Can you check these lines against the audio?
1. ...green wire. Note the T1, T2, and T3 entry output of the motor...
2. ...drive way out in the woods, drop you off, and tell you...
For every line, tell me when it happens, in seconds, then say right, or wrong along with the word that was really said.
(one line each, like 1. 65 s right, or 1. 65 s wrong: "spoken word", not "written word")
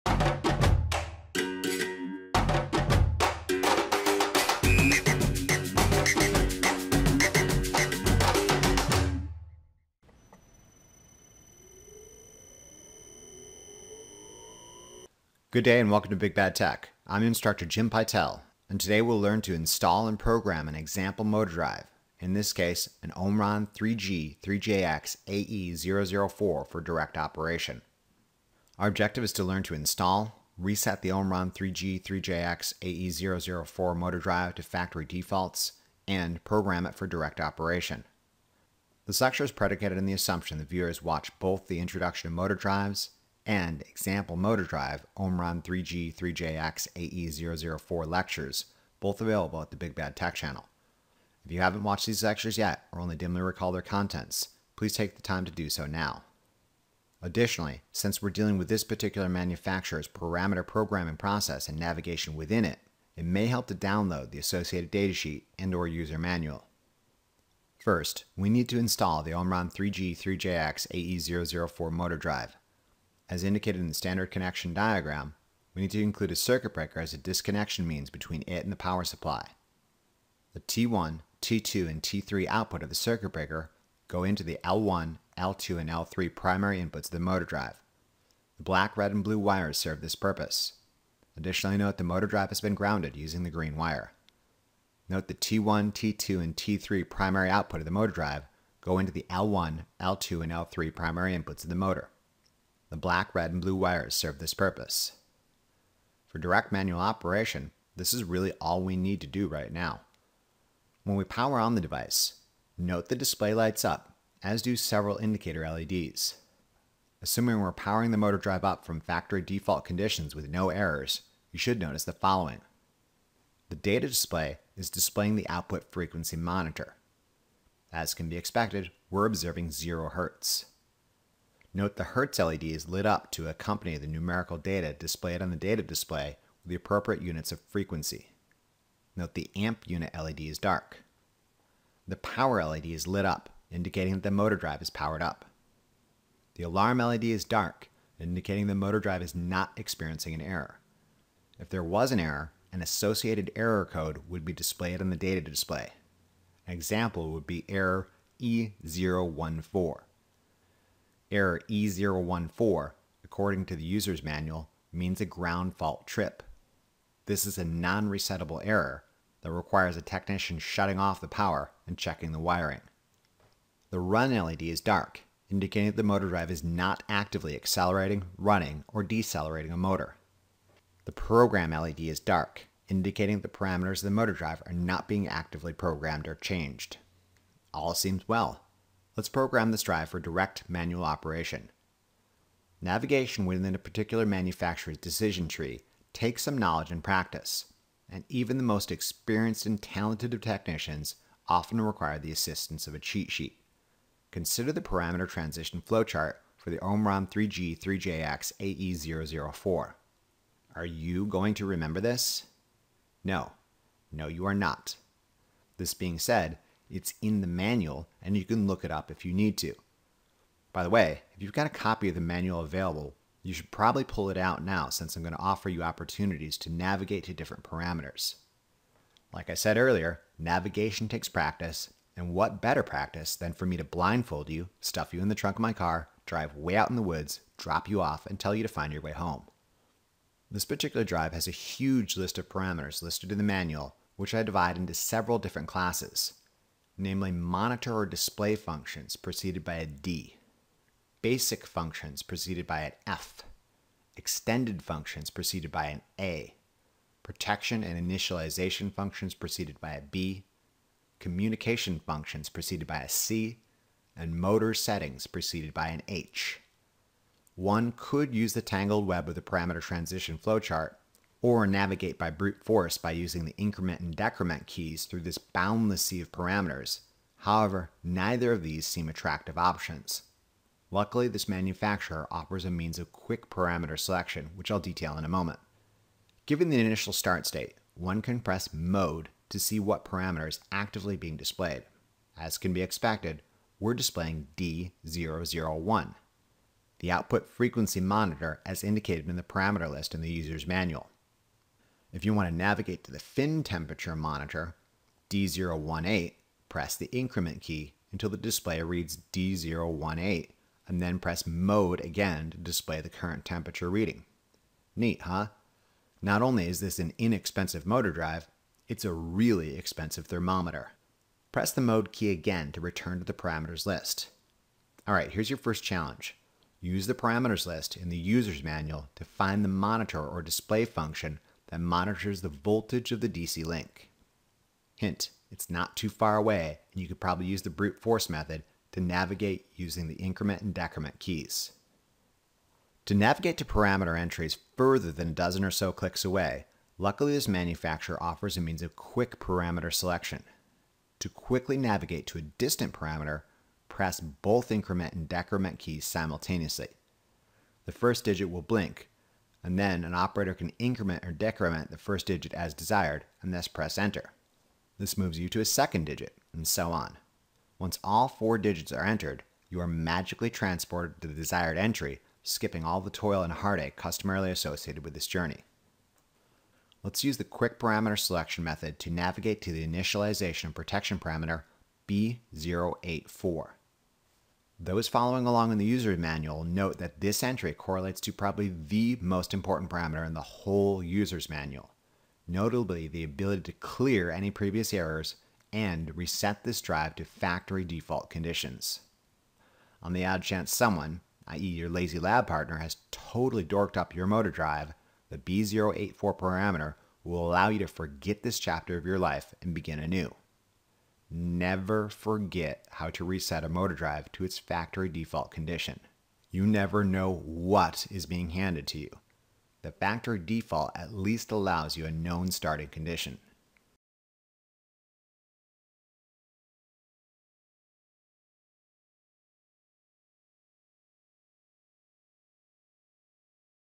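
1. 93 s wrong: "primary", not "entry"
2. 236 s right.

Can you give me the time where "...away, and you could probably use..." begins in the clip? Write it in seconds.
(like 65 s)
336 s.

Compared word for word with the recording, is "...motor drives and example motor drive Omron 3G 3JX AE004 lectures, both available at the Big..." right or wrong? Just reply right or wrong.
right.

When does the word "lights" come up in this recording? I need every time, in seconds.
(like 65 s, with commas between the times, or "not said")
113 s.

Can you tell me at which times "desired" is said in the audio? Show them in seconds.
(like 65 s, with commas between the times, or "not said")
362 s, 371 s.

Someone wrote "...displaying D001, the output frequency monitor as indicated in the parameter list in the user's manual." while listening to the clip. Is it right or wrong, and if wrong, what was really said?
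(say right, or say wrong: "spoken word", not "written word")
right.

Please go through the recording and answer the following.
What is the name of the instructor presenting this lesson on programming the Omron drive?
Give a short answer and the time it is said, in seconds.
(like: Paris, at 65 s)
Jim Pytel, at 17 s.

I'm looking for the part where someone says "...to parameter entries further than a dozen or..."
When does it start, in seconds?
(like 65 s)
343 s.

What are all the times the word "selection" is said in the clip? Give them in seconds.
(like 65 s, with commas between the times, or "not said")
283 s, 349 s, 378 s.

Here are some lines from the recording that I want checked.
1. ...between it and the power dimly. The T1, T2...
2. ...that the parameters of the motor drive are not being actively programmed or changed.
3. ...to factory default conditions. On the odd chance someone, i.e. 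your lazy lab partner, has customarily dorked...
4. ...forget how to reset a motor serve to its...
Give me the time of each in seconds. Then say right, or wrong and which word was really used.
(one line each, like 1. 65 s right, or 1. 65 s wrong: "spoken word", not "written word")
1. 78 s wrong: "supply", not "dimly"
2. 183 s right
3. 397 s wrong: "totally", not "customarily"
4. 412 s wrong: "drive", not "serve".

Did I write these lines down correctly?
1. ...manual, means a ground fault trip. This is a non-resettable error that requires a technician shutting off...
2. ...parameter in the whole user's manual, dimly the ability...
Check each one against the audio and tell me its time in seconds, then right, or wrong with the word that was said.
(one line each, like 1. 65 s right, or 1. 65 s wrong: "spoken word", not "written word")
1. 164 s right
2. 389 s wrong: "notably", not "dimly".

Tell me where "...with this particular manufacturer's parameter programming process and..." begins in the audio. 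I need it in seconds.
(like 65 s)
58 s.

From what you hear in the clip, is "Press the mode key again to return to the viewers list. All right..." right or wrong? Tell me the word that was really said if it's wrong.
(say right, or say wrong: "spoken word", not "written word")
wrong: "parameters", not "viewers".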